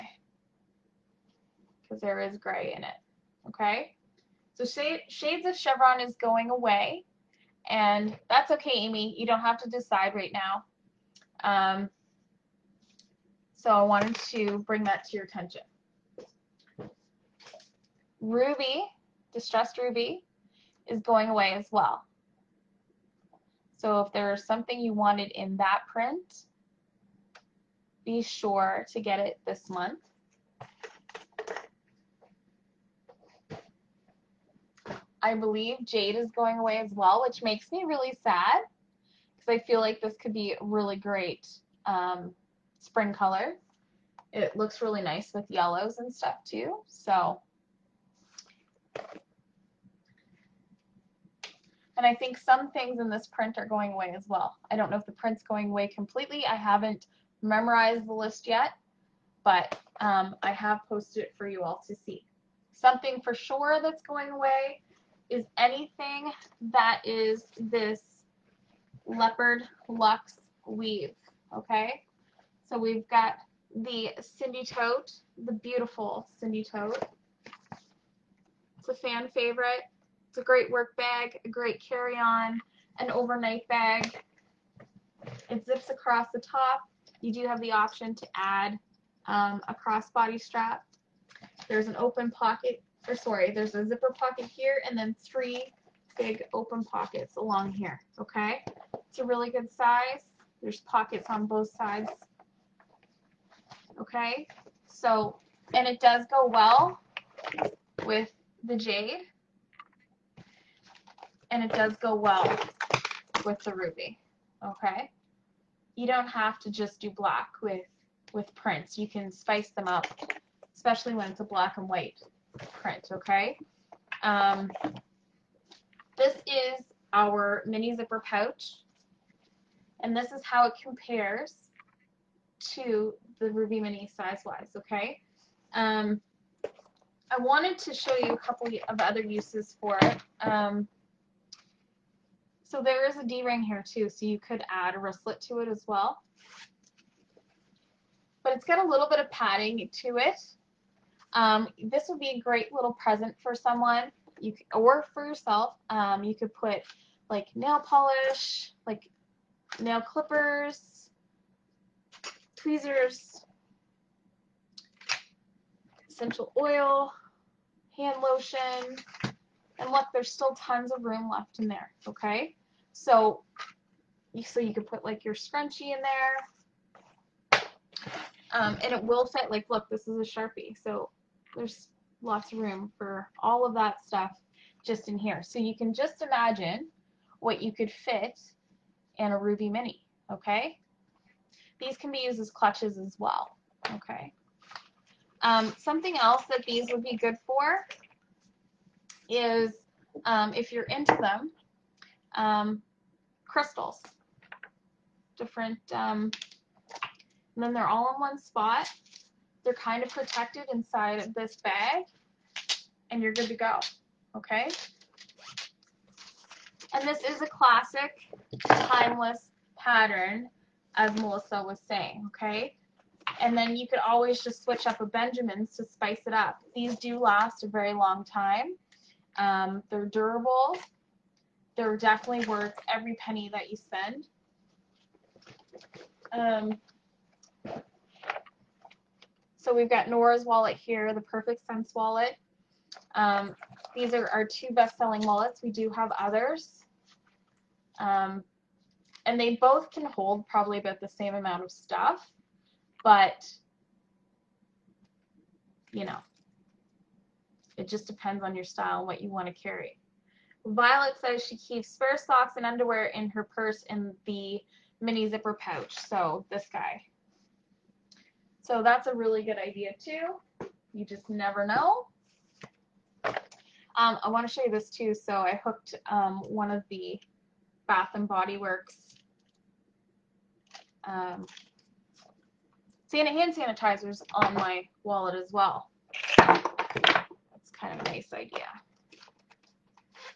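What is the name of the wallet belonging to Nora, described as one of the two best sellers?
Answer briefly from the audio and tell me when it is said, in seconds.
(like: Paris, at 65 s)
Perfect Cents, at 241 s.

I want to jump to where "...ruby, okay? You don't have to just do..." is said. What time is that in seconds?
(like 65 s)
113 s.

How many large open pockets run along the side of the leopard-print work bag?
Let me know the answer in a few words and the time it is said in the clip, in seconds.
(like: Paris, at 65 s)
3, at 95 s.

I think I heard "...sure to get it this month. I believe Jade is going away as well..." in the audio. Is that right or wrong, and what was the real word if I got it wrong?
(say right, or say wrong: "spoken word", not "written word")
right.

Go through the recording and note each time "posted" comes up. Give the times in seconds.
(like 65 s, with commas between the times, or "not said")
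60 s.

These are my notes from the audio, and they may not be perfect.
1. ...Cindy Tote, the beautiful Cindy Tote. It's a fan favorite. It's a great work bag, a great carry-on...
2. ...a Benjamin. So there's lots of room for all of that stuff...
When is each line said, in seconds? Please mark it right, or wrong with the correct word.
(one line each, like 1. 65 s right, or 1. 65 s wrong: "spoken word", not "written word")
1. 74 s right
2. 180 s wrong: "Sharpie", not "Benjamin".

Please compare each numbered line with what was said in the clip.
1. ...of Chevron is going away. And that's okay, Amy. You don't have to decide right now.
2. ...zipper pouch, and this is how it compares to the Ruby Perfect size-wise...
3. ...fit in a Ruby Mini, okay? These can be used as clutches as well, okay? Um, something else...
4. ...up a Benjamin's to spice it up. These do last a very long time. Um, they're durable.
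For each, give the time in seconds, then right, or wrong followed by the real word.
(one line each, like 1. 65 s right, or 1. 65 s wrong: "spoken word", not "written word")
1. 5 s right
2. 127 s wrong: "Mini", not "Perfect"
3. 187 s right
4. 224 s right.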